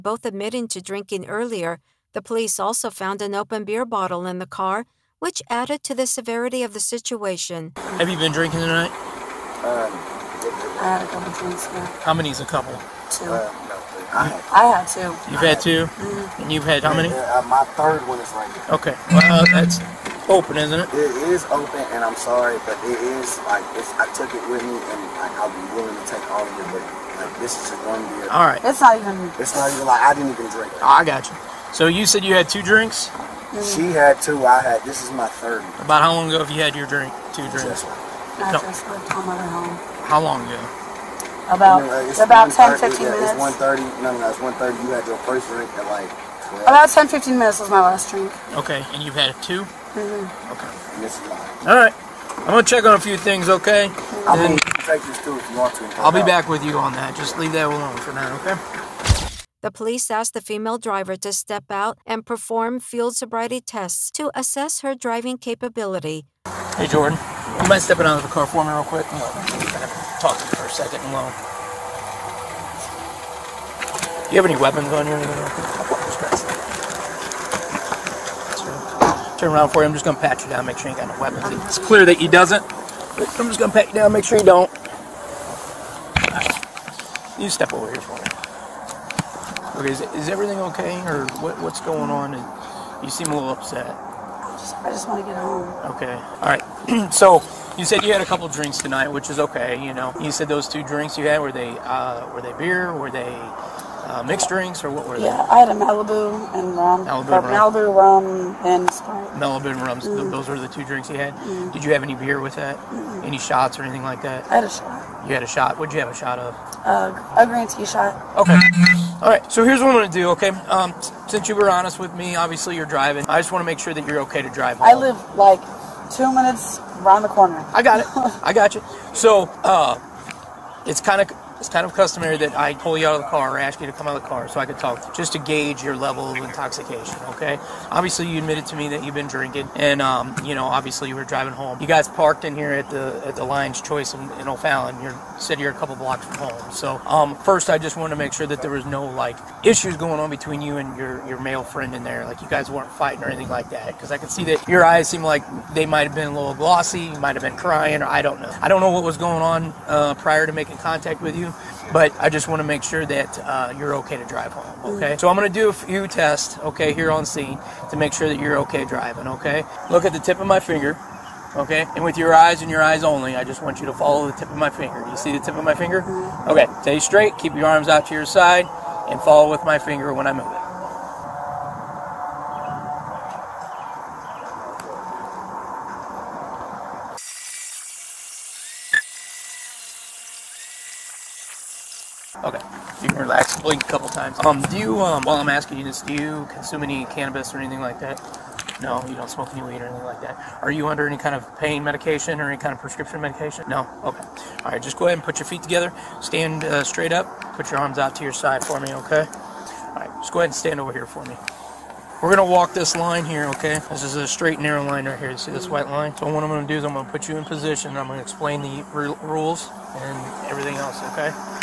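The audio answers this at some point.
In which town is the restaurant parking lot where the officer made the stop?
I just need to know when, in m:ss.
2:24.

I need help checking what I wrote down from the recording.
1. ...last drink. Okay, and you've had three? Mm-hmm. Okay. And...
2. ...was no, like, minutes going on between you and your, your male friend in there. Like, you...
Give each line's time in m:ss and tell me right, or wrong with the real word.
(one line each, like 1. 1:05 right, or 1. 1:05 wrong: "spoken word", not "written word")
1. 0:47 wrong: "two", not "three"
2. 2:28 wrong: "issues", not "minutes".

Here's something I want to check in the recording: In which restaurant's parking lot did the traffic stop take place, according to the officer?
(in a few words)
Lion's Choice.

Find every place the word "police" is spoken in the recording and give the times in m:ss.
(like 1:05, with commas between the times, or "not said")
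0:02, 0:59.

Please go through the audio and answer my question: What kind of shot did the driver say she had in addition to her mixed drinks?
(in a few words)
Green tea shot.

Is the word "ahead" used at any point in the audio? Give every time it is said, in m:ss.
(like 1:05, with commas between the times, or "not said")
3:25, 3:30.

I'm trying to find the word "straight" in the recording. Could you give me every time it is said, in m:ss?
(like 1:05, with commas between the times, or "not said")
2:56, 3:26, 3:34.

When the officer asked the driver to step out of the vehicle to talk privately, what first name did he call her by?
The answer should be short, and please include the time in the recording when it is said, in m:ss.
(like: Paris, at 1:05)
Jordan, at 1:06.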